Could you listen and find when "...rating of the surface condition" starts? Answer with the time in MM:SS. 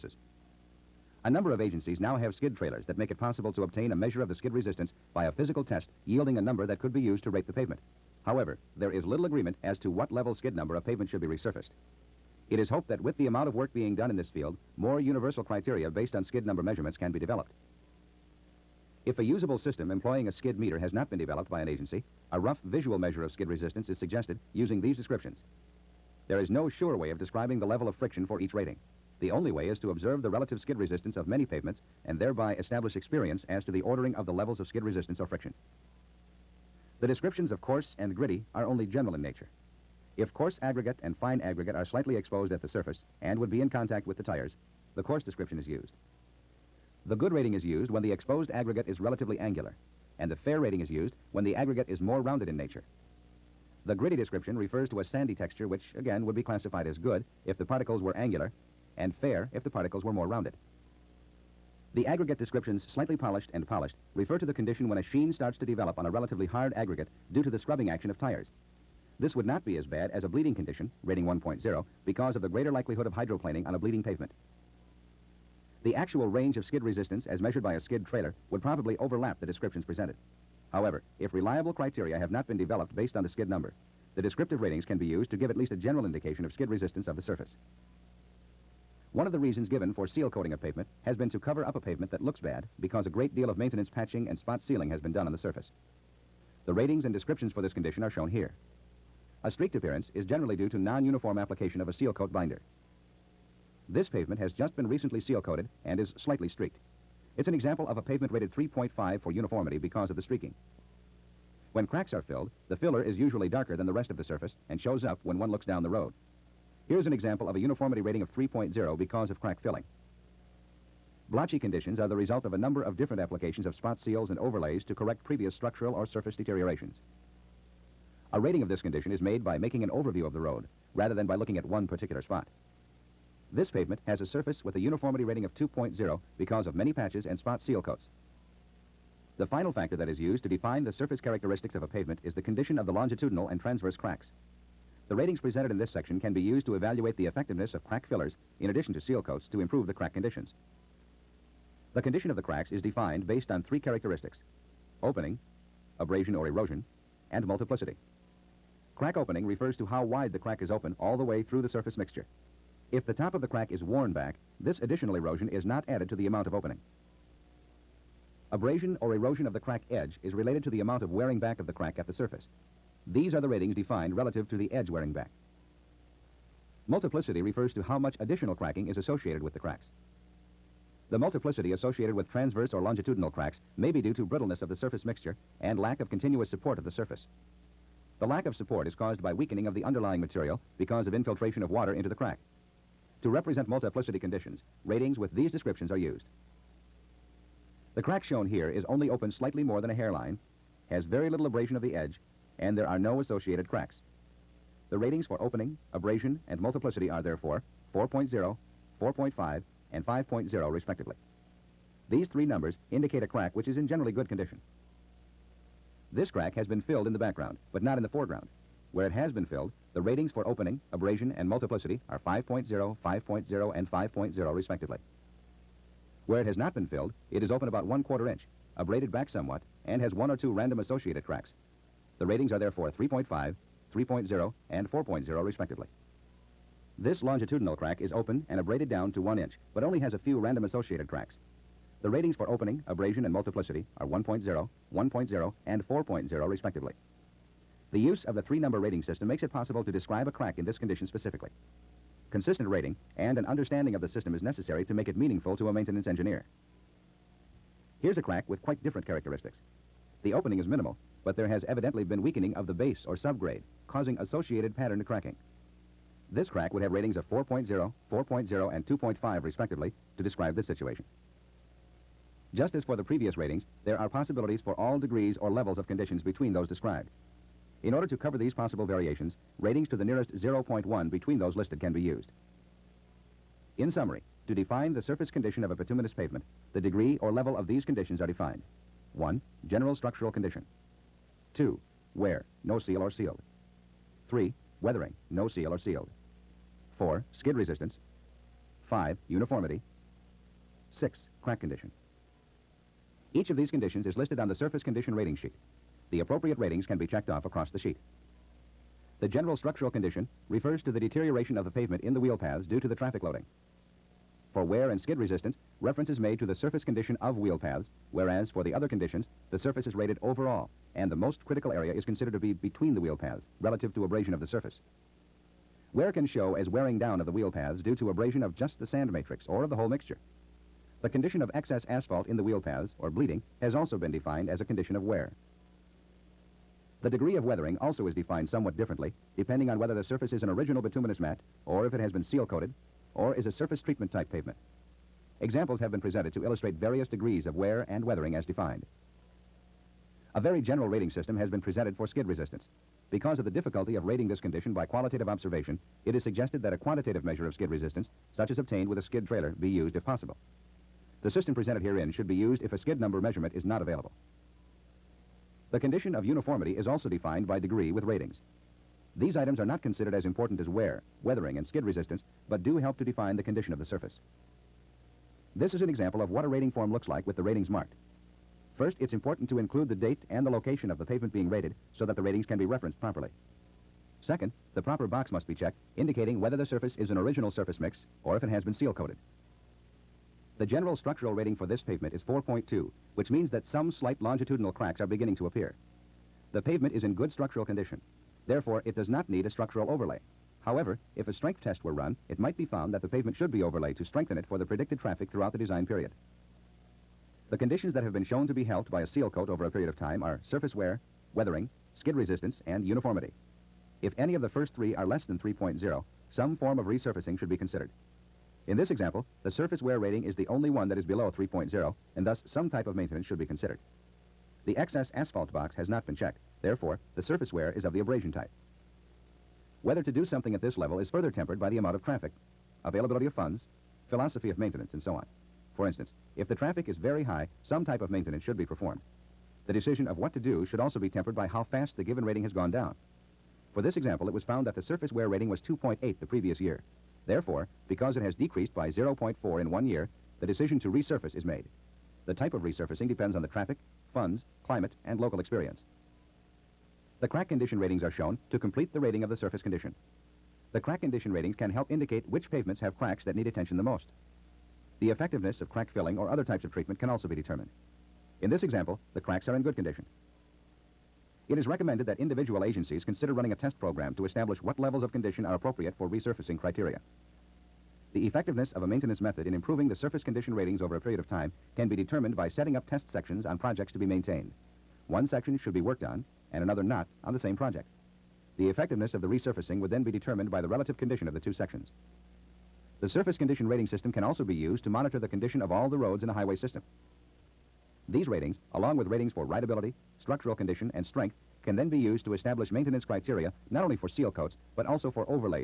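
07:39.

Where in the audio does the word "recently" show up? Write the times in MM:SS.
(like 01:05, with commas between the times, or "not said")
01:44.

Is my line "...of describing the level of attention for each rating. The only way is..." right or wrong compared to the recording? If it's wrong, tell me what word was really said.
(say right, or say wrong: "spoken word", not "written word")
wrong: "friction", not "attention".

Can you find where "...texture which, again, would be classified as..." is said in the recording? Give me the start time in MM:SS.
00:55.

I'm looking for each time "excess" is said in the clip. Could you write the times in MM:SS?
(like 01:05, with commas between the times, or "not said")
05:31, 07:04.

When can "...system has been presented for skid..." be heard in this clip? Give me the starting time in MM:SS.
05:51.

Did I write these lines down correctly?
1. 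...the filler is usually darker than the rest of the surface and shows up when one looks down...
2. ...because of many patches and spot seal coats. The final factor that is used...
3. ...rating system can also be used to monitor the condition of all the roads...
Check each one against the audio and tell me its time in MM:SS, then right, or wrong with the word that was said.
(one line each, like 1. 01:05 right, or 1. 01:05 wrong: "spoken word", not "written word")
1. 01:52 right
2. 02:16 right
3. 08:13 right.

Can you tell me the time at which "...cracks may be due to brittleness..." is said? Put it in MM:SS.
03:03.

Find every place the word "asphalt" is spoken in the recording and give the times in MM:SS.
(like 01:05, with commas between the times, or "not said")
05:31, 07:05.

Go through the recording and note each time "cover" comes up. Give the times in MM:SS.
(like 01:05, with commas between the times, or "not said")
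01:31, 04:38.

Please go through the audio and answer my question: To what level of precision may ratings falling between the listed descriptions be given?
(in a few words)
nearest 0.1.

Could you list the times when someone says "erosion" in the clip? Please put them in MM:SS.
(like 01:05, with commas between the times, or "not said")
02:36, 02:45, 02:49.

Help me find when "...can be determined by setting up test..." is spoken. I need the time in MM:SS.
08:01.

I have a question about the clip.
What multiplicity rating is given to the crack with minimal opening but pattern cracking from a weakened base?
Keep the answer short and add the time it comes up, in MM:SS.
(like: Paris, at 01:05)
2.5, at 04:28.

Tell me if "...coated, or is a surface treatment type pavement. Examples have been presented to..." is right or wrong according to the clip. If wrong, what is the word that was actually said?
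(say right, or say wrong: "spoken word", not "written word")
right.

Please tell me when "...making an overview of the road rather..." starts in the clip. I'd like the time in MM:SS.
02:09.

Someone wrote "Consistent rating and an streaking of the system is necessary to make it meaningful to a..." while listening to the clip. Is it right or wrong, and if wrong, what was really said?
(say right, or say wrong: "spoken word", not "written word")
wrong: "understanding", not "streaking".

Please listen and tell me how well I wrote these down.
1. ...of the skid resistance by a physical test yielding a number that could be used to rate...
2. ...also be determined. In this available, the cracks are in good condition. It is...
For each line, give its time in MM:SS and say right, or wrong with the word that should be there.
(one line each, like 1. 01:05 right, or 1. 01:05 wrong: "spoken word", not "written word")
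1. 00:04 right
2. 07:47 wrong: "example", not "available".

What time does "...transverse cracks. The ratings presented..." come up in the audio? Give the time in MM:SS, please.
02:23.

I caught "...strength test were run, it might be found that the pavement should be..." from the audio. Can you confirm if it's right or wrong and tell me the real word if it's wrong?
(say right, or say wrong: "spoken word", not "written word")
right.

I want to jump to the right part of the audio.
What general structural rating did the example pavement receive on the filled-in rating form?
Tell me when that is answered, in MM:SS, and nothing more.
06:32.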